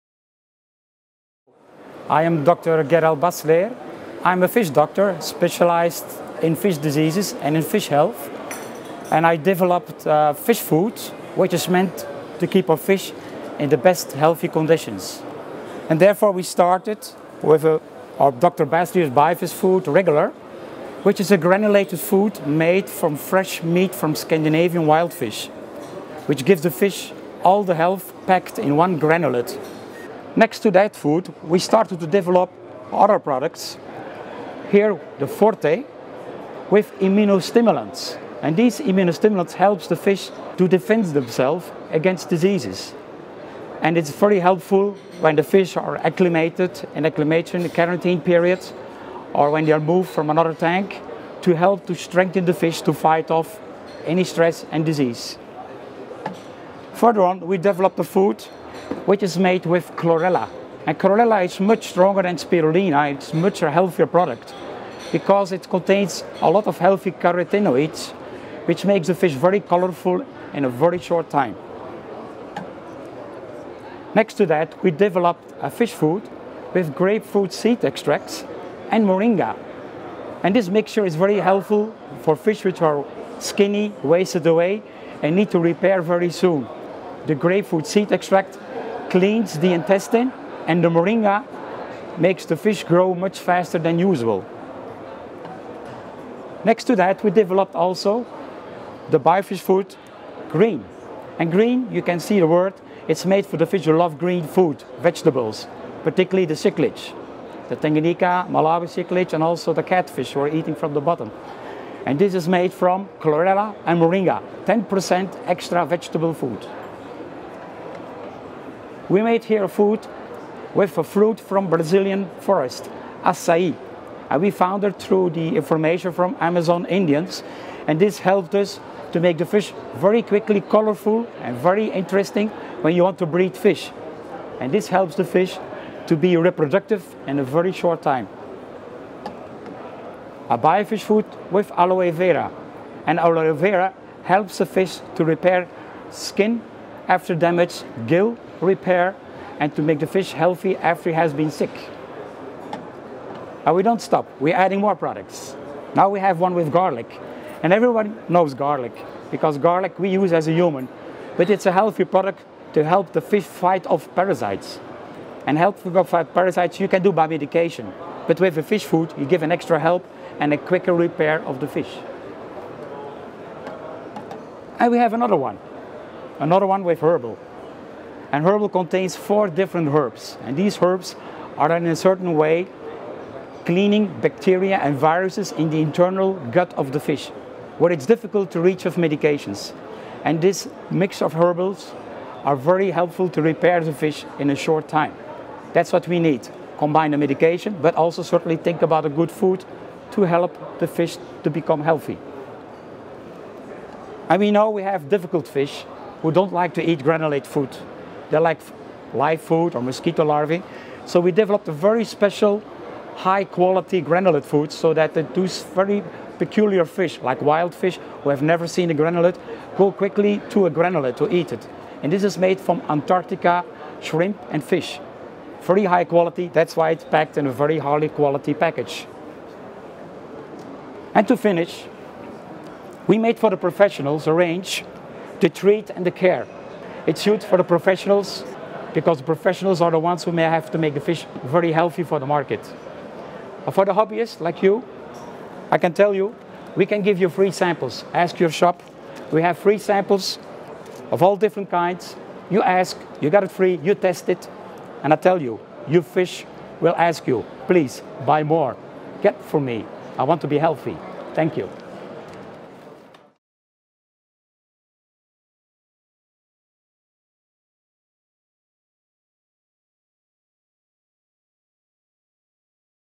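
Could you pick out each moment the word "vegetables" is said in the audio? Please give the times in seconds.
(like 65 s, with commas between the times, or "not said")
105 s, 115 s.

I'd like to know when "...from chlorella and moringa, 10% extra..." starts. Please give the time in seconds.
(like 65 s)
112 s.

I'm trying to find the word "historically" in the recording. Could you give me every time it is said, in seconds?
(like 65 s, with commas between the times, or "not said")
not said.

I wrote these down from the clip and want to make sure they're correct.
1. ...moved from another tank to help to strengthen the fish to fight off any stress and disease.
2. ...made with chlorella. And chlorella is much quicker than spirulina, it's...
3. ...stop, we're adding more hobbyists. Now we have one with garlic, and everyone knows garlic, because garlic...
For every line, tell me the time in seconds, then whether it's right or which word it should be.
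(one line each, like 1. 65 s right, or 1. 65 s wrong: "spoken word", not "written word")
1. 49 s right
2. 59 s wrong: "stronger", not "quicker"
3. 154 s wrong: "products", not "hobbyists".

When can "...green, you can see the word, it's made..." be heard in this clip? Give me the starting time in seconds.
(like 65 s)
101 s.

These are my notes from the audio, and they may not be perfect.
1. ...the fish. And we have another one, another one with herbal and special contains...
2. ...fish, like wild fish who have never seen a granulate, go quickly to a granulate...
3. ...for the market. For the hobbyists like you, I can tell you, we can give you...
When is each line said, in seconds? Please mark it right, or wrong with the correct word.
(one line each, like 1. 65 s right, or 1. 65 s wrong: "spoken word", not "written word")
1. 171 s wrong: "herbal", not "special"
2. 216 s right
3. 242 s right.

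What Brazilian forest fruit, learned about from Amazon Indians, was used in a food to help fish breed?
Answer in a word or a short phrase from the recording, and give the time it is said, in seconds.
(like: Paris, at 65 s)
Acai, at 123 s.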